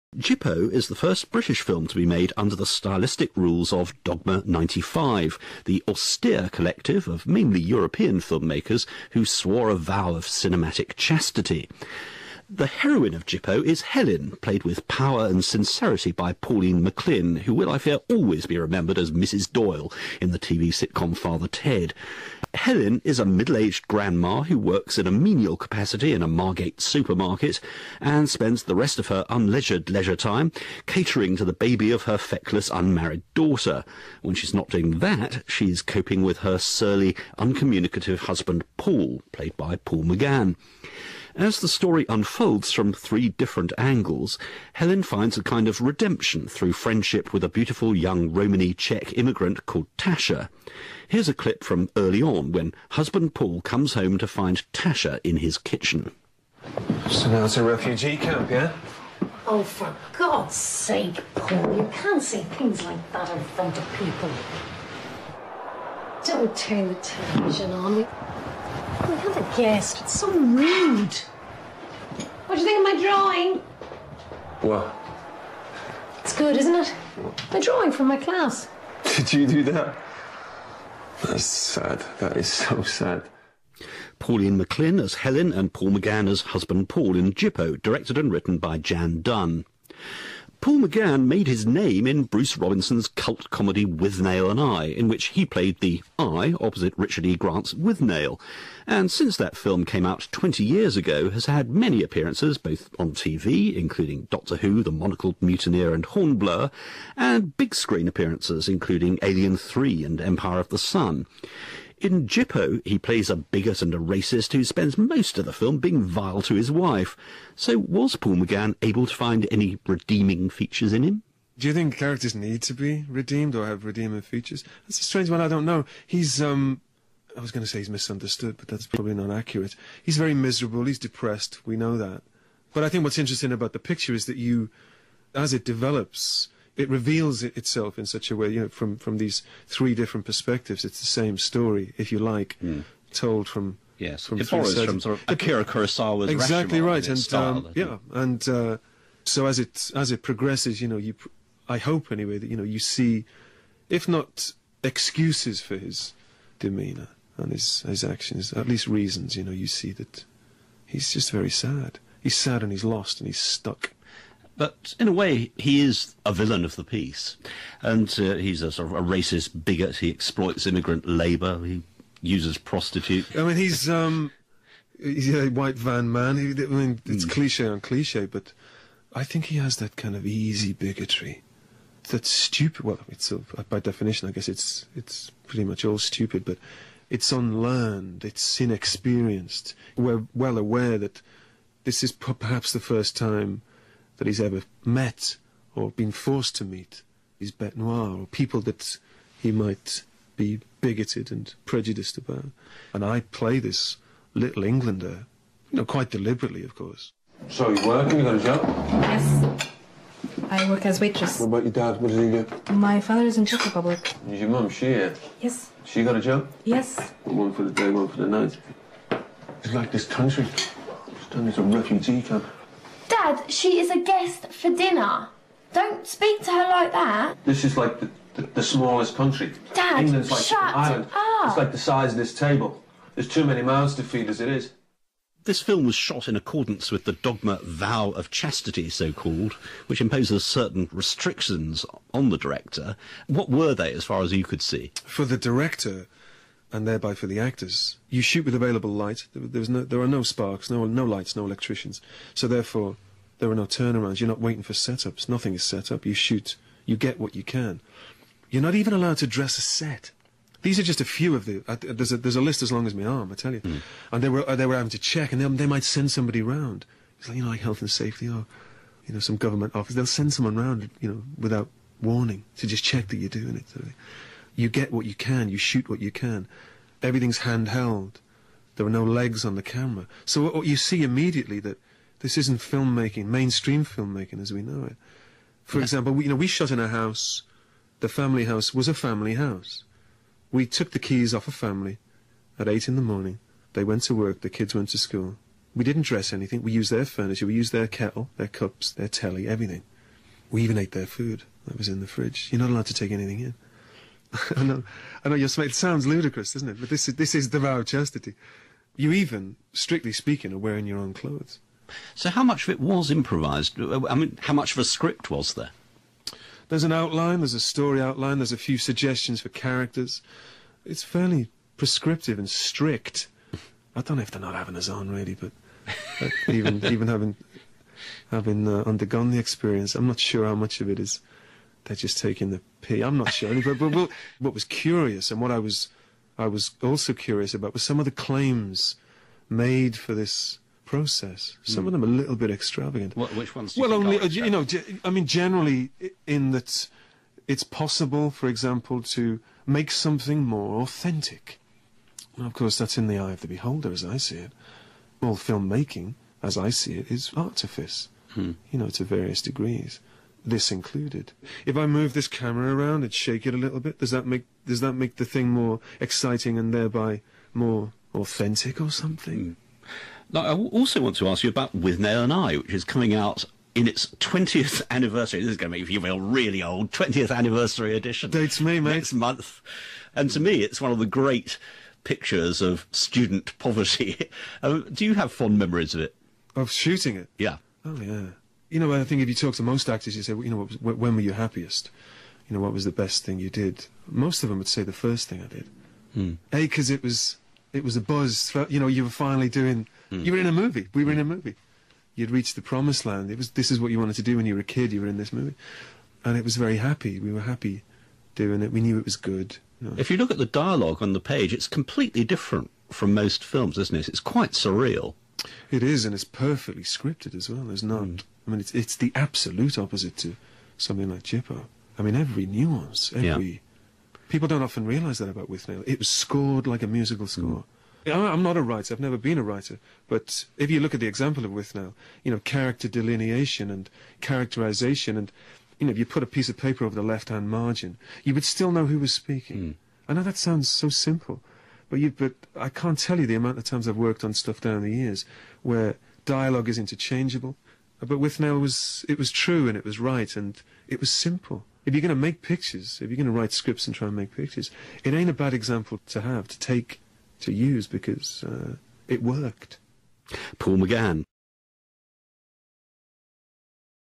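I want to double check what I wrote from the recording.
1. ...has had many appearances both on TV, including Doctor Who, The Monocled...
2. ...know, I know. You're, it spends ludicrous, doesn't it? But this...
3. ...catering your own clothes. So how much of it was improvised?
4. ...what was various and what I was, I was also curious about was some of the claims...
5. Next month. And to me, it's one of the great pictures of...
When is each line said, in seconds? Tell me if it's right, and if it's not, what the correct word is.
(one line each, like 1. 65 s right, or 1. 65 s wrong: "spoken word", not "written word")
1. 101 s right
2. 304 s wrong: "sounds", not "spends"
3. 310 s wrong: "wearing", not "catering"
4. 334 s wrong: "curious", not "various"
5. 378 s right.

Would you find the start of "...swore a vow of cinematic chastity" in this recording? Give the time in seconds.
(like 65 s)
9 s.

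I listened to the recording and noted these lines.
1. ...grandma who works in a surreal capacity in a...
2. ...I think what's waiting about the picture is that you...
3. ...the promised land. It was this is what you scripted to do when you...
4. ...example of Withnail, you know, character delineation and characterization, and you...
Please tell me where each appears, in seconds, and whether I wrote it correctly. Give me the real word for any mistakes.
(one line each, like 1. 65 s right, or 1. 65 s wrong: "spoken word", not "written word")
1. 23 s wrong: "menial", not "surreal"
2. 132 s wrong: "interesting", not "waiting"
3. 402 s wrong: "wanted", not "scripted"
4. 431 s right.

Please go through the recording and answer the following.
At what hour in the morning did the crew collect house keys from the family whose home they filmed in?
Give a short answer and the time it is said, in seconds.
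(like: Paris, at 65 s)
8, at 292 s.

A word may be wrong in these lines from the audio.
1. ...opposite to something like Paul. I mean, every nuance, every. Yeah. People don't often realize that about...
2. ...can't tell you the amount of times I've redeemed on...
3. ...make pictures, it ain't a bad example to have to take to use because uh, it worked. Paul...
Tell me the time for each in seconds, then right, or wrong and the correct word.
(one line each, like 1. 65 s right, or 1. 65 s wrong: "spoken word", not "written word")
1. 419 s wrong: "Gypo", not "Paul"
2. 442 s wrong: "worked", not "redeemed"
3. 454 s right.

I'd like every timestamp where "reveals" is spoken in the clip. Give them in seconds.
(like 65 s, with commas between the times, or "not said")
136 s.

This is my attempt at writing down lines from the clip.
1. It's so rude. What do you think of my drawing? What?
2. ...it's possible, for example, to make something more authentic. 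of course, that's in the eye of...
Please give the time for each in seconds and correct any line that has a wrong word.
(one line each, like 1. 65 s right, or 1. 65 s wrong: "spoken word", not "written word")
1. 70 s right
2. 347 s right.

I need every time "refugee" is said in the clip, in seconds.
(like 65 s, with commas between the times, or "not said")
57 s, 221 s.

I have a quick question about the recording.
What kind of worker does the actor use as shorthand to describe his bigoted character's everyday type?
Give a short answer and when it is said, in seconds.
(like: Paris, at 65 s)
white van man, at 175 s.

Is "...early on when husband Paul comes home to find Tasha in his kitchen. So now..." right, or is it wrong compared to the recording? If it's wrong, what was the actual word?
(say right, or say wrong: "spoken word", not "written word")
right.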